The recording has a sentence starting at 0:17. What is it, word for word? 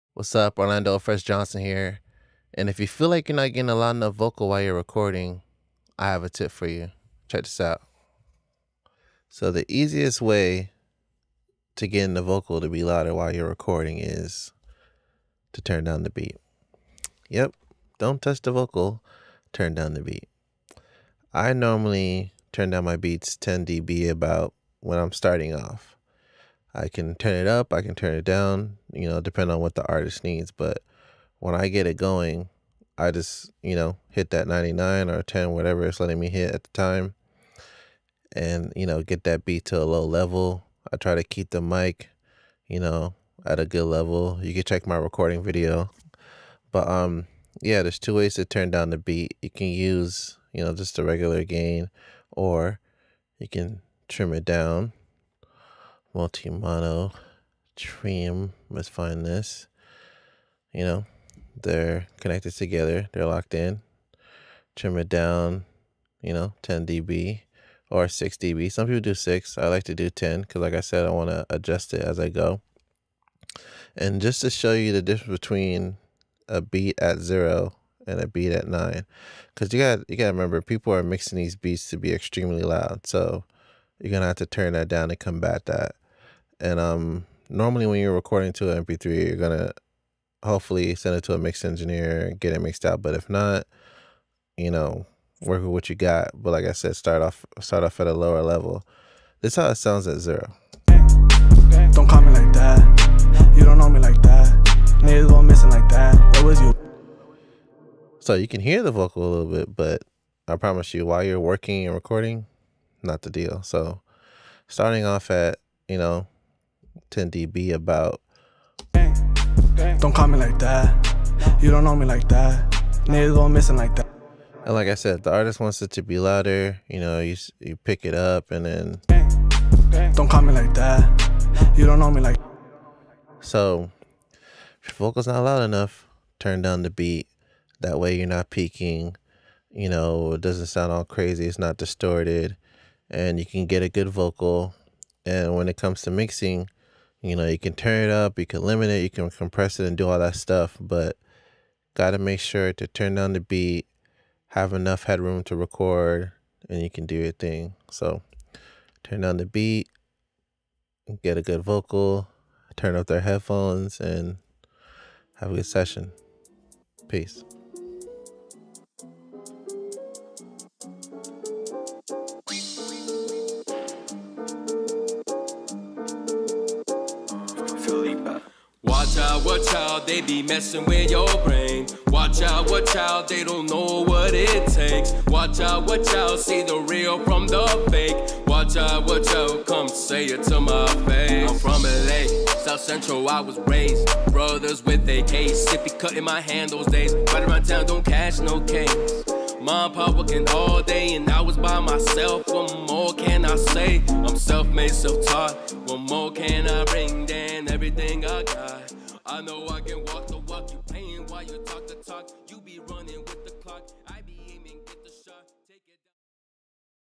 Yep, don't touch the vocal, turn down the beat.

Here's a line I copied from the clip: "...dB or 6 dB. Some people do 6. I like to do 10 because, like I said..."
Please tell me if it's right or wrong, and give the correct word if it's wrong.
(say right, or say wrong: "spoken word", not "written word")
right.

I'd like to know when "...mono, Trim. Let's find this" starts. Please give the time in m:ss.
0:56.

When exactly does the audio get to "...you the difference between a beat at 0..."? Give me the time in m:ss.
1:14.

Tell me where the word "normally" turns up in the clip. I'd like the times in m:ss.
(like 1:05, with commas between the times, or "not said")
0:21, 1:27.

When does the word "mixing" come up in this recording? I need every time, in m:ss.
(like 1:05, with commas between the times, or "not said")
1:21, 2:26.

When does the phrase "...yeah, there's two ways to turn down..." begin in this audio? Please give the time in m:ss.
0:47.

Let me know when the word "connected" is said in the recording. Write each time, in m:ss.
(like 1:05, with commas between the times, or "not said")
1:02.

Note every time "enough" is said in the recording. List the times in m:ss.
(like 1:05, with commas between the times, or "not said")
0:03, 2:15, 2:34.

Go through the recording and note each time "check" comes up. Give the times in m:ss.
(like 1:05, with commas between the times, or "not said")
0:07, 0:44.